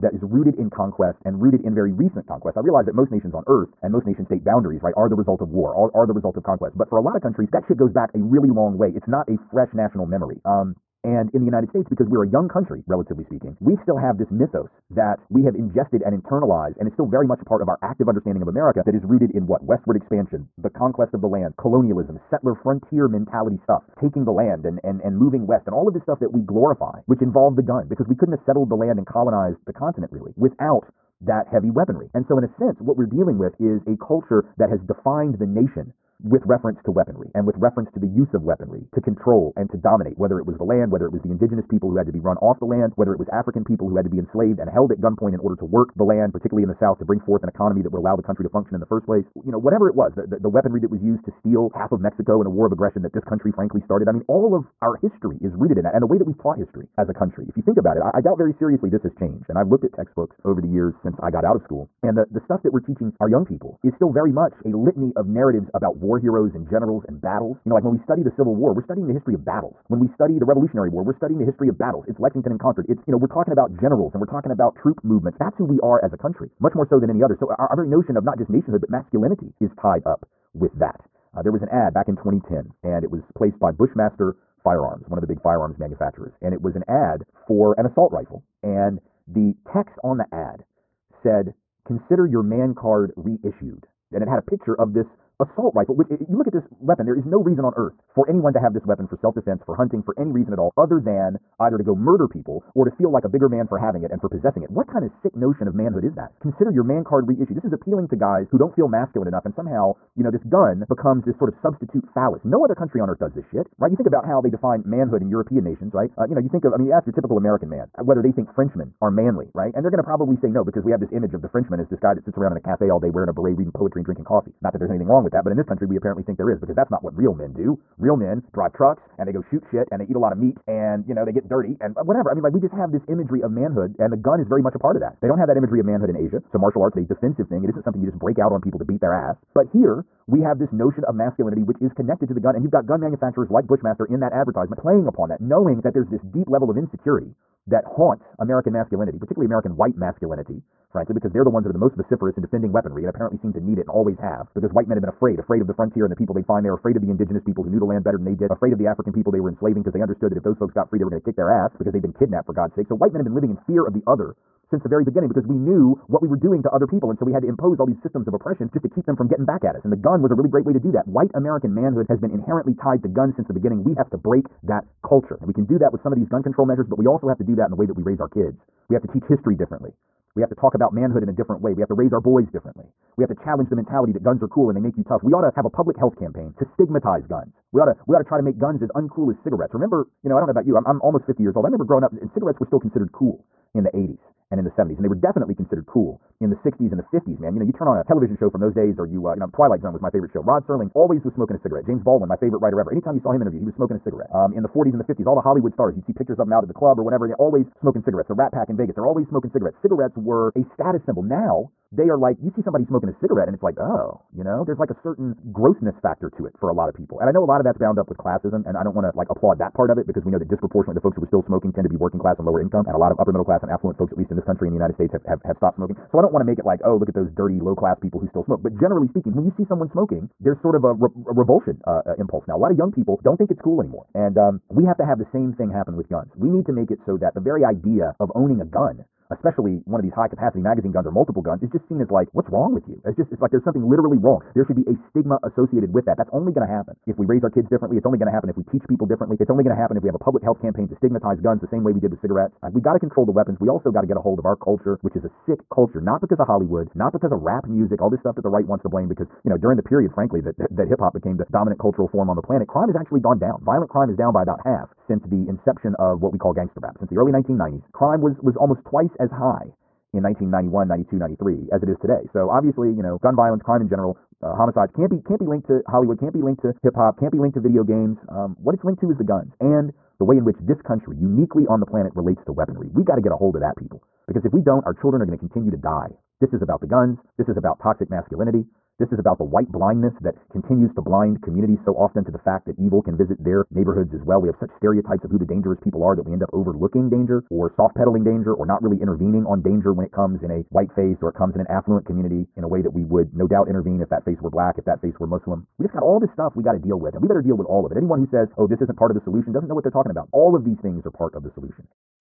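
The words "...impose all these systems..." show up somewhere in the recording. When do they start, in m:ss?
2:47.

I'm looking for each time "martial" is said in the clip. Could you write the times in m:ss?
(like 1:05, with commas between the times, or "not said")
2:16.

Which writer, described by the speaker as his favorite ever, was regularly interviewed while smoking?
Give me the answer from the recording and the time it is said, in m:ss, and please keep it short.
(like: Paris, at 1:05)
James Baldwin, at 3:21.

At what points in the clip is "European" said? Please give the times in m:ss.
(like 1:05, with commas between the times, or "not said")
1:55.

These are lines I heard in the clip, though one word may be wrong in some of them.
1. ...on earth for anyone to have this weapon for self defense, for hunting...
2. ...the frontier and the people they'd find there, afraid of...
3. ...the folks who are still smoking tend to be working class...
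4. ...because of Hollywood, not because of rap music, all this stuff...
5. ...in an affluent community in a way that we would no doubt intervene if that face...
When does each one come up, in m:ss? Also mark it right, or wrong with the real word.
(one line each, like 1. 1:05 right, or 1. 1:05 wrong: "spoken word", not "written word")
1. 1:37 right
2. 2:35 right
3. 3:40 right
4. 4:16 right
5. 5:01 right.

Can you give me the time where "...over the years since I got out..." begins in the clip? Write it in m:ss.
1:00.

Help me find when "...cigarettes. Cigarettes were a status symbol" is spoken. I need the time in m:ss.
3:29.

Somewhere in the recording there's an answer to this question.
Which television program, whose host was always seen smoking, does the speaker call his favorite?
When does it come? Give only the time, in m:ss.
3:19.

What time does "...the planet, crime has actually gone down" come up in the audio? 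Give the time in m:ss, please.
4:22.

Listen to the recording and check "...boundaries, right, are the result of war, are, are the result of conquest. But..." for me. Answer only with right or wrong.
right.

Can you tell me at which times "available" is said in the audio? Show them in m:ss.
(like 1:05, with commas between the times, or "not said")
not said.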